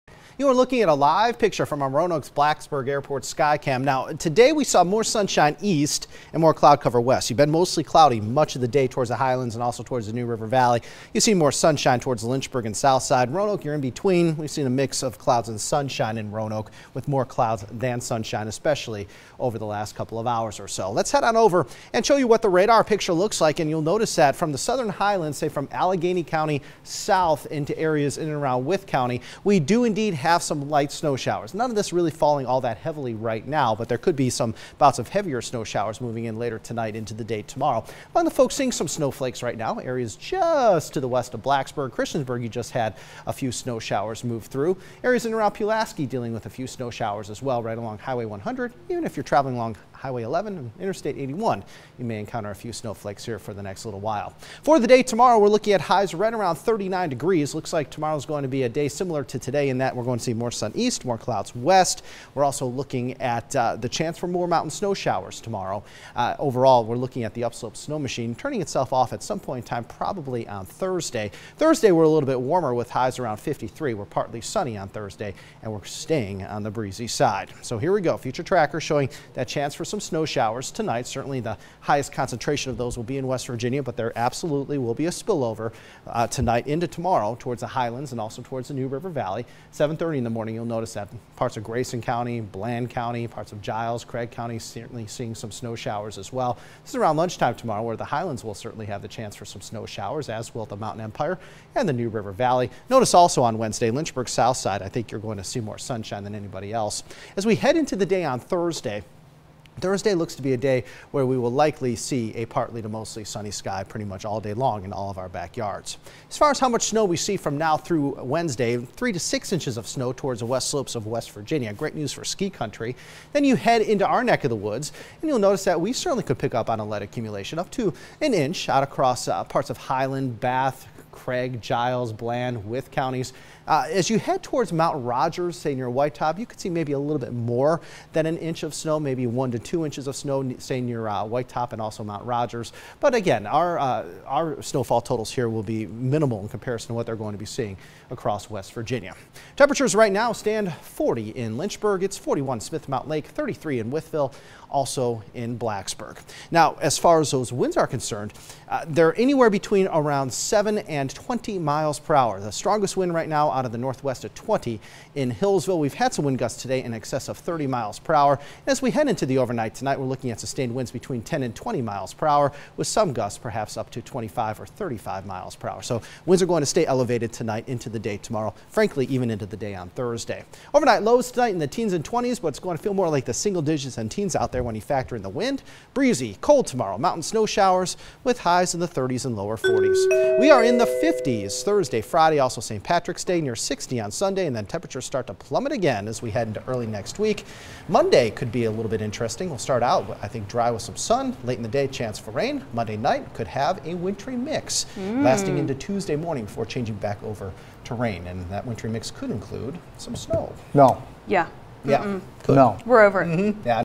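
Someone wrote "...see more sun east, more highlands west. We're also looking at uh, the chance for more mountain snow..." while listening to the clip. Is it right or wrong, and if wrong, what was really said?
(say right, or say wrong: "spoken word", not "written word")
wrong: "clouds", not "highlands".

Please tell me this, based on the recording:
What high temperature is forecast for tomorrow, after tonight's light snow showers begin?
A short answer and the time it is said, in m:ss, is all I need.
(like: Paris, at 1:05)
39 degrees, at 0:56.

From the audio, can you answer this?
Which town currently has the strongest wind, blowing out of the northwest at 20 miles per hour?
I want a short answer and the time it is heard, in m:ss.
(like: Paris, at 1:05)
Hillsville, at 2:45.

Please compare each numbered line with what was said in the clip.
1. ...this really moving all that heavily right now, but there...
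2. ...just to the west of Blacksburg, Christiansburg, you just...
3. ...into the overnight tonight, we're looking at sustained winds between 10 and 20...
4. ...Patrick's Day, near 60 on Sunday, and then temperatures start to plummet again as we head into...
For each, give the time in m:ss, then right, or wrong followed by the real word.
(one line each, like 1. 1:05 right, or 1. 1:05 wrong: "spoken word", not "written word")
1. 0:31 wrong: "falling", not "moving"
2. 0:40 right
3. 2:49 right
4. 3:12 right.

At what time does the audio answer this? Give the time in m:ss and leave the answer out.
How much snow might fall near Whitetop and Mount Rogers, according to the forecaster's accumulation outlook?
2:19.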